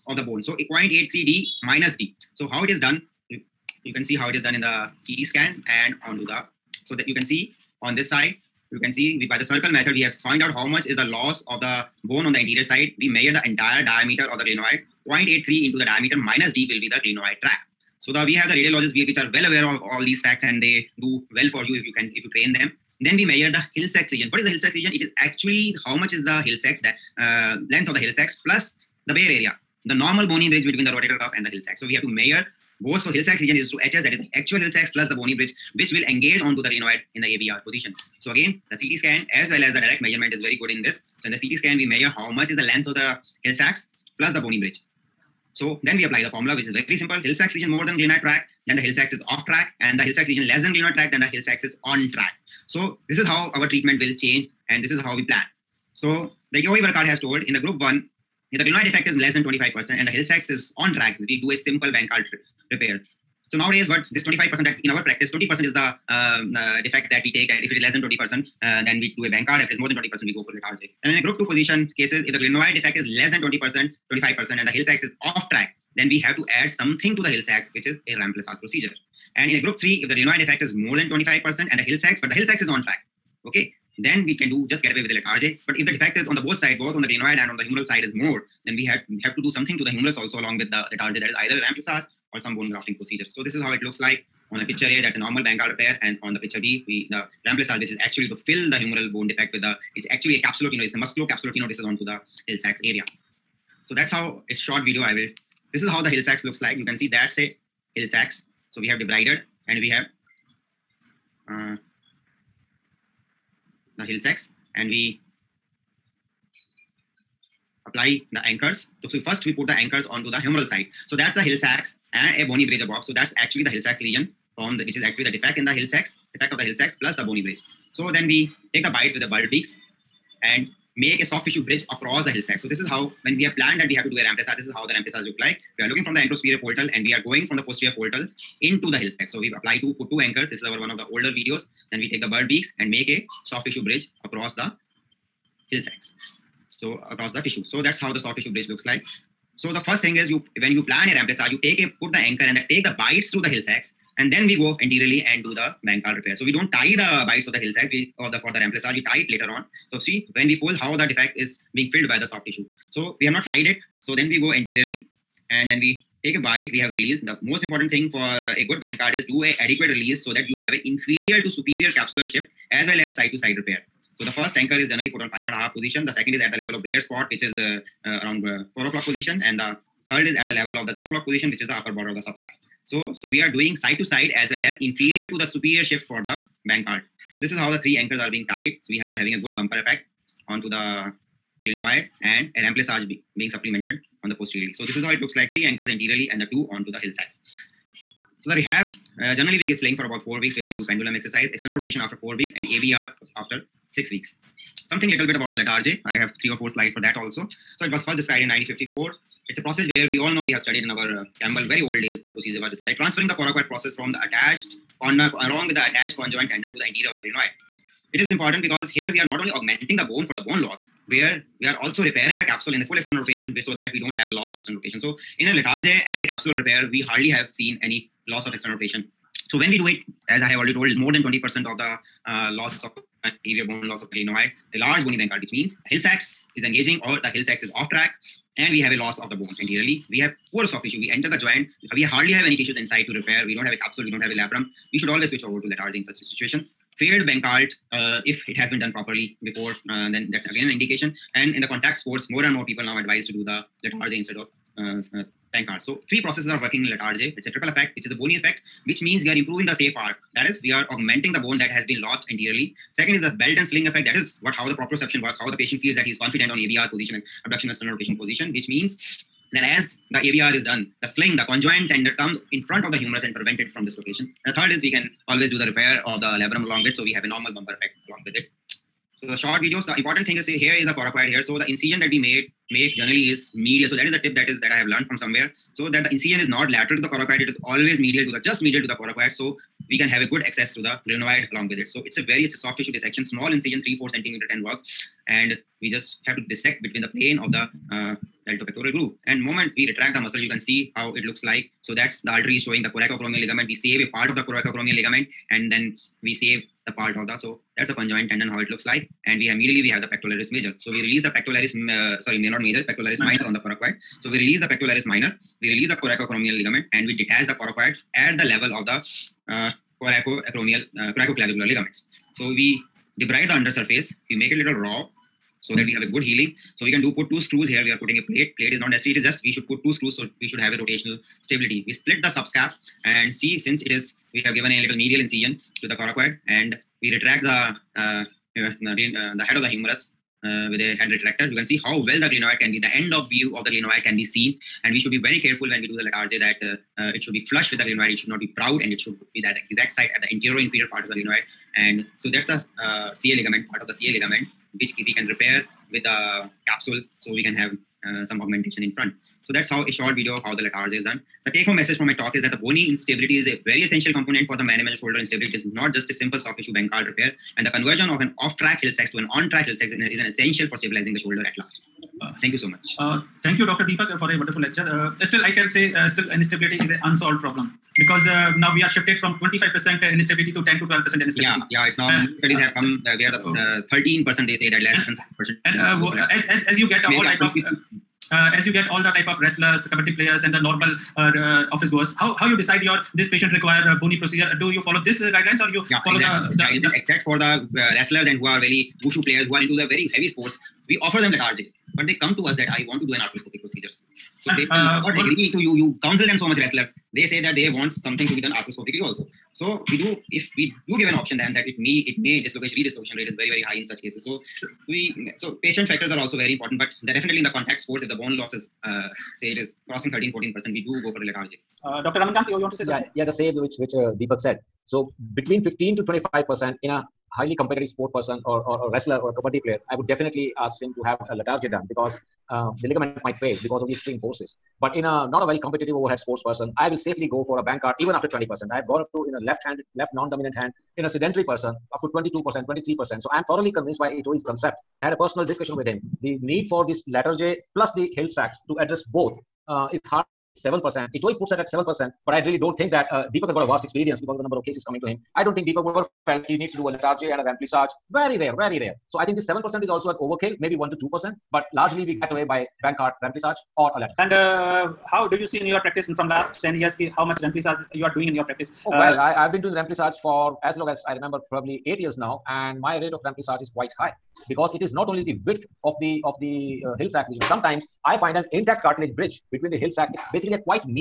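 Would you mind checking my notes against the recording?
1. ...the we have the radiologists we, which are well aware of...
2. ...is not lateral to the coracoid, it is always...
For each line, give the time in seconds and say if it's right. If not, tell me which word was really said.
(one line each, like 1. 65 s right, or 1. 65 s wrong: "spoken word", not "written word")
1. 18 s right
2. 286 s right.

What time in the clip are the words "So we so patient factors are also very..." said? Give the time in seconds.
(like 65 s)
414 s.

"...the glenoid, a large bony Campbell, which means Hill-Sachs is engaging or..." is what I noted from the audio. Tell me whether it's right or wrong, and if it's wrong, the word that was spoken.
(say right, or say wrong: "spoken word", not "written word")
wrong: "Bankart", not "Campbell".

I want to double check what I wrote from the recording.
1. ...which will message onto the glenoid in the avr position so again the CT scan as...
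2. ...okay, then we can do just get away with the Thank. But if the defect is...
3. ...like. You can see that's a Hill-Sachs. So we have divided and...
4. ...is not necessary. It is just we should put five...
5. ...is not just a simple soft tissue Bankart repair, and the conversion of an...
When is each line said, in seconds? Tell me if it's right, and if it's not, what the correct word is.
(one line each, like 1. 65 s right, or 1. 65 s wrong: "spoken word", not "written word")
1. 35 s wrong: "engage", not "message"
2. 83 s wrong: "Latarjet", not "Thank"
3. 106 s right
4. 328 s wrong: "two", not "five"
5. 365 s right.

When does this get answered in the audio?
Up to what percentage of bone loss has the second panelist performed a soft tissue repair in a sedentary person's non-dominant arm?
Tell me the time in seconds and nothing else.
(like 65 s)
442 s.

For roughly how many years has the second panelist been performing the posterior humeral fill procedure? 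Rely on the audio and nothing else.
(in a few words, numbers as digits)
8.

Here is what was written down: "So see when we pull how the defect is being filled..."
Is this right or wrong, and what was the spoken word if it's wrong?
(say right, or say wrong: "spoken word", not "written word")
right.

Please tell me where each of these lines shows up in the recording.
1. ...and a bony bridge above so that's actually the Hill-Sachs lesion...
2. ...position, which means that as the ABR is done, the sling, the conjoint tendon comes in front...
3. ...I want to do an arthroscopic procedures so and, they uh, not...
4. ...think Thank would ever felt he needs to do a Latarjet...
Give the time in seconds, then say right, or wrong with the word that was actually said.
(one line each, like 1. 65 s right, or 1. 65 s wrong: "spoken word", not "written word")
1. 122 s right
2. 268 s right
3. 402 s right
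4. 455 s wrong: "Deepak", not "Thank".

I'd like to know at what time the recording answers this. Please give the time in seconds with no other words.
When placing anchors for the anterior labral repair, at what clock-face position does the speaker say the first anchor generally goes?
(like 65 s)
175 s.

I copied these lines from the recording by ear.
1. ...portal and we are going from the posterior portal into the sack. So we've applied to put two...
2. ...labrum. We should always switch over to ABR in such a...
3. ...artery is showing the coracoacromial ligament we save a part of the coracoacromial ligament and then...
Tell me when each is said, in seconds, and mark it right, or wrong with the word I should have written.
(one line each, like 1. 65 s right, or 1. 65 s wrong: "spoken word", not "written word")
1. 136 s right
2. 244 s wrong: "Latarjet", not "ABR"
3. 302 s right.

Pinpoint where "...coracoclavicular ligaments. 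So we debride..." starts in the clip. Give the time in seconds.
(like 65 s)
321 s.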